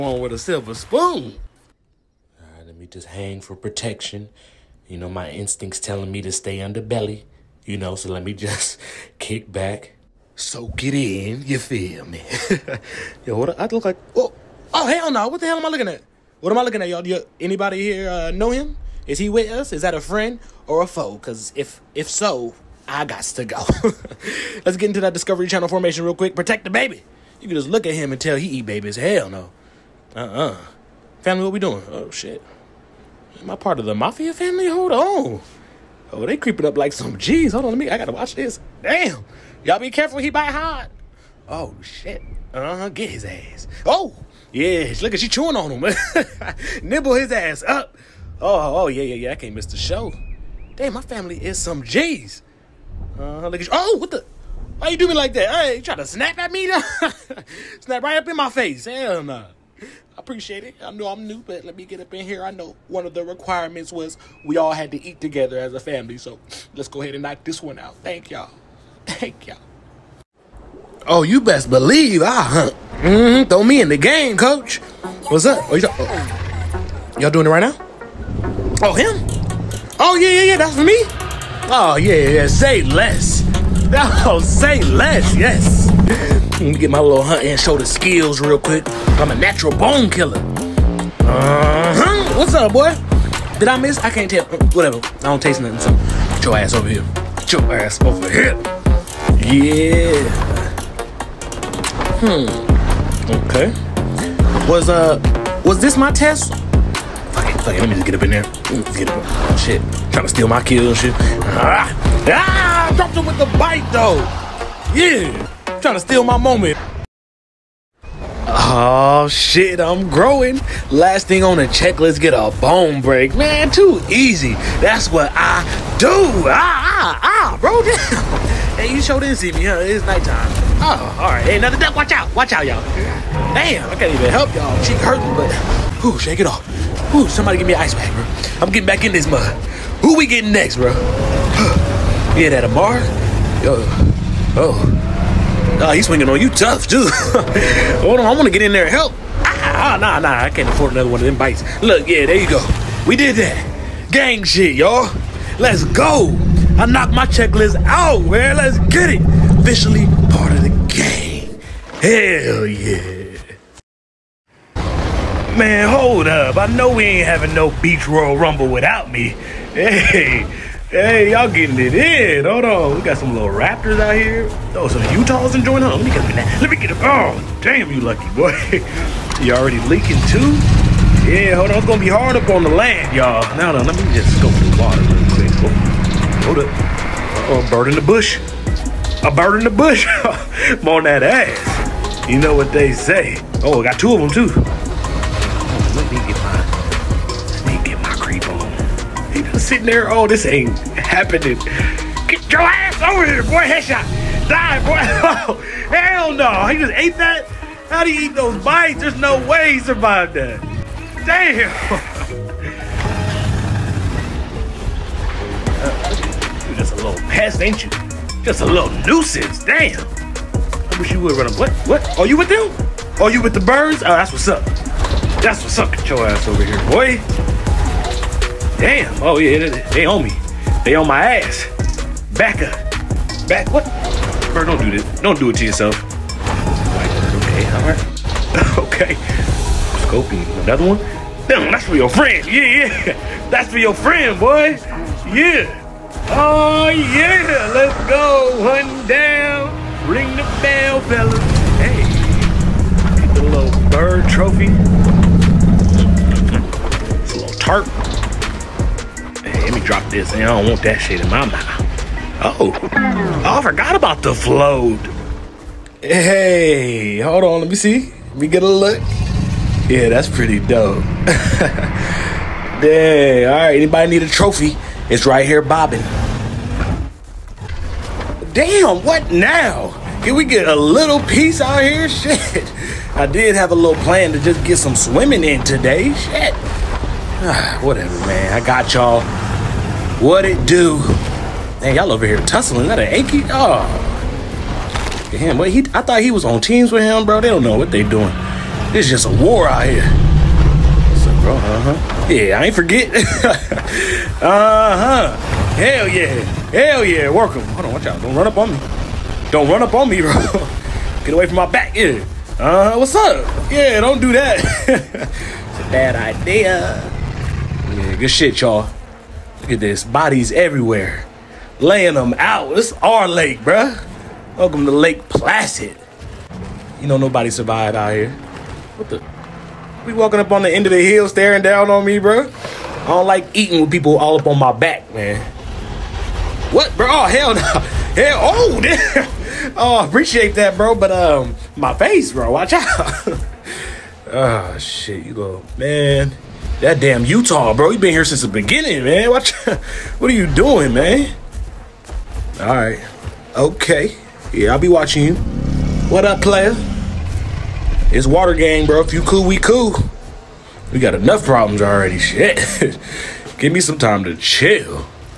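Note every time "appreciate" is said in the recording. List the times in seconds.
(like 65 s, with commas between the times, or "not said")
60 s, 340 s.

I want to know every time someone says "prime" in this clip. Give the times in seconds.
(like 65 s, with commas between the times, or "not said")
not said.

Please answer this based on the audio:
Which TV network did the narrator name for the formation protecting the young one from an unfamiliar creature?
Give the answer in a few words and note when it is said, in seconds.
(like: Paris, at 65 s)
Discovery Channel, at 25 s.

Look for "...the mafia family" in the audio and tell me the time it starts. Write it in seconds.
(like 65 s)
33 s.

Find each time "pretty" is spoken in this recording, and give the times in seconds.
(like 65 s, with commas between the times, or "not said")
270 s.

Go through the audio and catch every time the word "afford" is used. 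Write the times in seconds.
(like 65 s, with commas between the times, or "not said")
150 s.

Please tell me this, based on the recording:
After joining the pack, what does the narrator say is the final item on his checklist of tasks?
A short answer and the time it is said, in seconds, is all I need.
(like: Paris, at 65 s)
get a bone break, at 122 s.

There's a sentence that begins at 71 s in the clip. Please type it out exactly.
Oh, you best believe I hunt.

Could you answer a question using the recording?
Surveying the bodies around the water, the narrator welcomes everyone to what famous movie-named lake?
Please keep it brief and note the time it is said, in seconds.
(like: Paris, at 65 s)
Lake Placid, at 324 s.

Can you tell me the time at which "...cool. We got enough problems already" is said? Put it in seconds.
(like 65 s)
359 s.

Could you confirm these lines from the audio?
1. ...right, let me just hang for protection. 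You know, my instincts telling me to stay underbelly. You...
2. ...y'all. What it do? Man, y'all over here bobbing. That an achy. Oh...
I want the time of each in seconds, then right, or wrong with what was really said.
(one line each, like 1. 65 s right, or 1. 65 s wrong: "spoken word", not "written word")
1. 2 s right
2. 288 s wrong: "tussling", not "bobbing".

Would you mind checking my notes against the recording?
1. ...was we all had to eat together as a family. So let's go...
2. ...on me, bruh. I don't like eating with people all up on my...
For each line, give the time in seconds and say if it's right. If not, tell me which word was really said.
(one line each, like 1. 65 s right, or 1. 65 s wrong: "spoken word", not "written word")
1. 63 s right
2. 331 s right.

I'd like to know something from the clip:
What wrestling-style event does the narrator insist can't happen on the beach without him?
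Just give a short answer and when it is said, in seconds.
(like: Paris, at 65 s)
Beach Royal Rumble, at 167 s.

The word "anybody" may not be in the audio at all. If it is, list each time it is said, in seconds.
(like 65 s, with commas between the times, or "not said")
17 s, 273 s.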